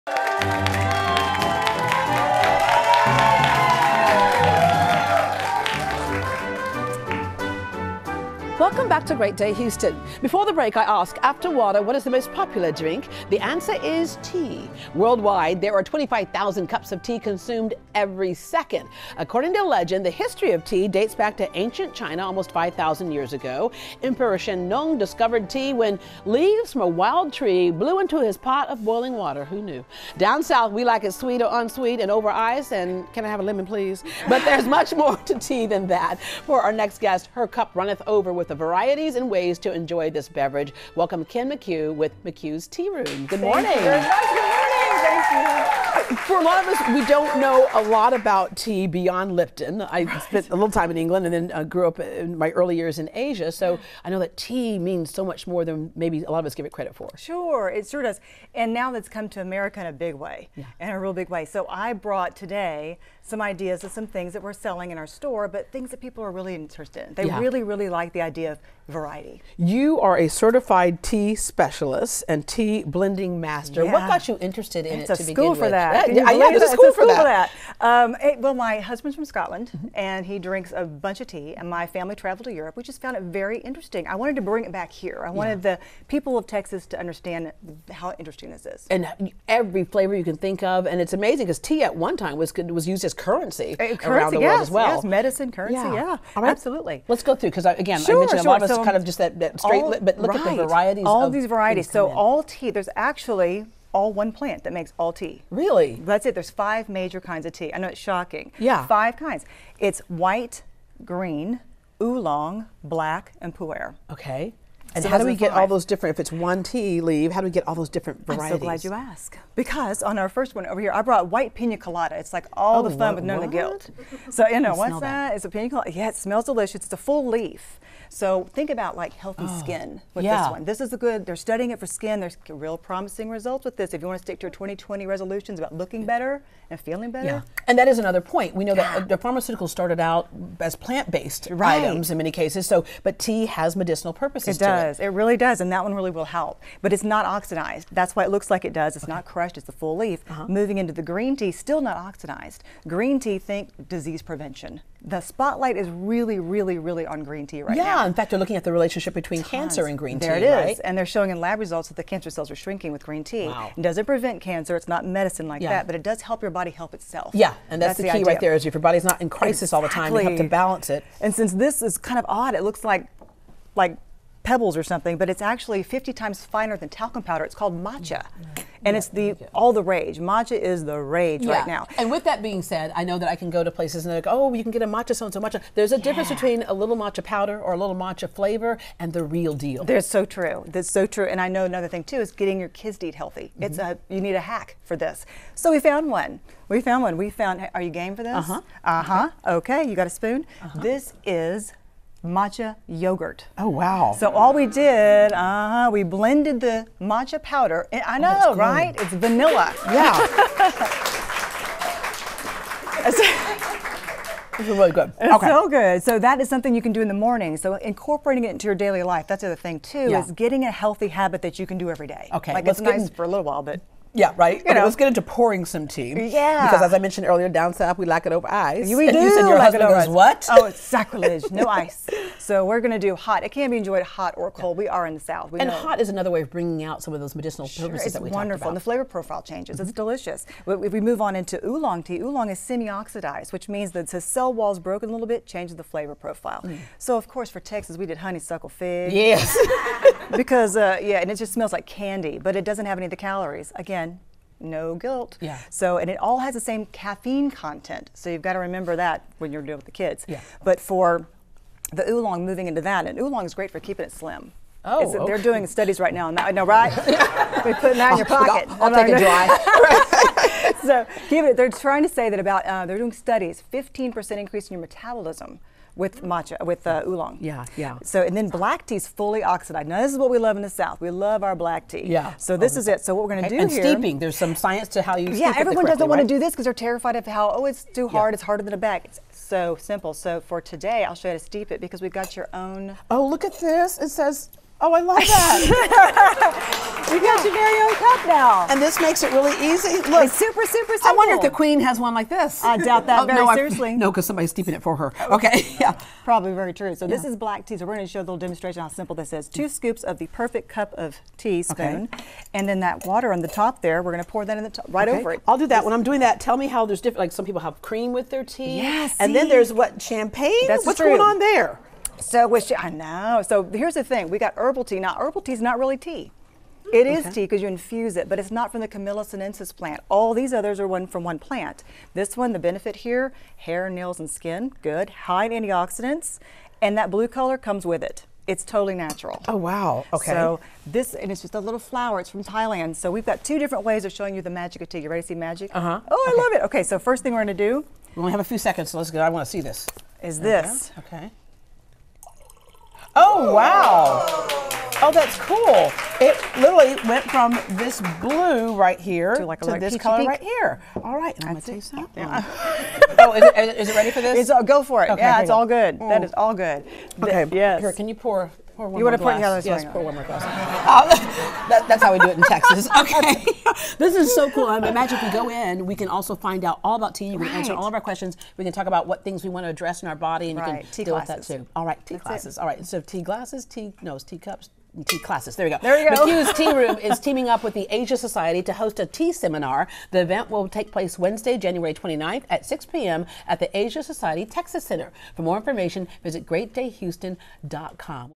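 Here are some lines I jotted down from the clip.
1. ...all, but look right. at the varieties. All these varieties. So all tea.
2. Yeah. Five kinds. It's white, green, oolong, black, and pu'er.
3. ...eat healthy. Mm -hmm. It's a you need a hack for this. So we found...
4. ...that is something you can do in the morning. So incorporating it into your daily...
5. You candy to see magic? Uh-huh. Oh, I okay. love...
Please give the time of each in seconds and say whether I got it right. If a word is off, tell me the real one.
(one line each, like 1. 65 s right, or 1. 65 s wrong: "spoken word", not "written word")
1. 99 s right
2. 108 s right
3. 193 s right
4. 216 s right
5. 344 s wrong: "ready", not "candy".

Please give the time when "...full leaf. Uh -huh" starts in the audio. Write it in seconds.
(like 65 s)
149 s.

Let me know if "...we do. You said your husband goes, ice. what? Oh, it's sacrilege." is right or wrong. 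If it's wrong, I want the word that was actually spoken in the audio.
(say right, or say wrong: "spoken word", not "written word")
right.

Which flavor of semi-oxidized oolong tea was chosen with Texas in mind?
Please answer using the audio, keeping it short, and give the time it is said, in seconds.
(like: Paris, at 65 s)
honeysuckle fig, at 248 s.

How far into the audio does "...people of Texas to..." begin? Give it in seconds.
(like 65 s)
86 s.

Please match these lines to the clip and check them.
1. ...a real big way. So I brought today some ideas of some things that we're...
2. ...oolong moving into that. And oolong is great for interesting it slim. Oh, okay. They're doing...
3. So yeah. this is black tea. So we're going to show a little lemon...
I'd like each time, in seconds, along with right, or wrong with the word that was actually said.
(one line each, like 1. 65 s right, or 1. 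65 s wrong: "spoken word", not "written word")
1. 60 s right
2. 262 s wrong: "keeping", not "interesting"
3. 306 s wrong: "demonstration", not "lemon".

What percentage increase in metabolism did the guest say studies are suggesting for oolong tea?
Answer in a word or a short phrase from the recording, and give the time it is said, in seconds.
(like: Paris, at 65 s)
15%, at 273 s.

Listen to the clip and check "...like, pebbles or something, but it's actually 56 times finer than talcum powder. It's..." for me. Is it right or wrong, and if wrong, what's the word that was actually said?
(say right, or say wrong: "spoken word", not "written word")
wrong: "50", not "56".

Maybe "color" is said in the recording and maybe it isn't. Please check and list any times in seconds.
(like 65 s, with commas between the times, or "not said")
337 s, 359 s.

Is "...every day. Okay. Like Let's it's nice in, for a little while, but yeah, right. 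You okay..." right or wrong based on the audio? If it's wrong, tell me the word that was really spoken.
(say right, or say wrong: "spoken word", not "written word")
right.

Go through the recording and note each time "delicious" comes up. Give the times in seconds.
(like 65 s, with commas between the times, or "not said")
126 s, 240 s.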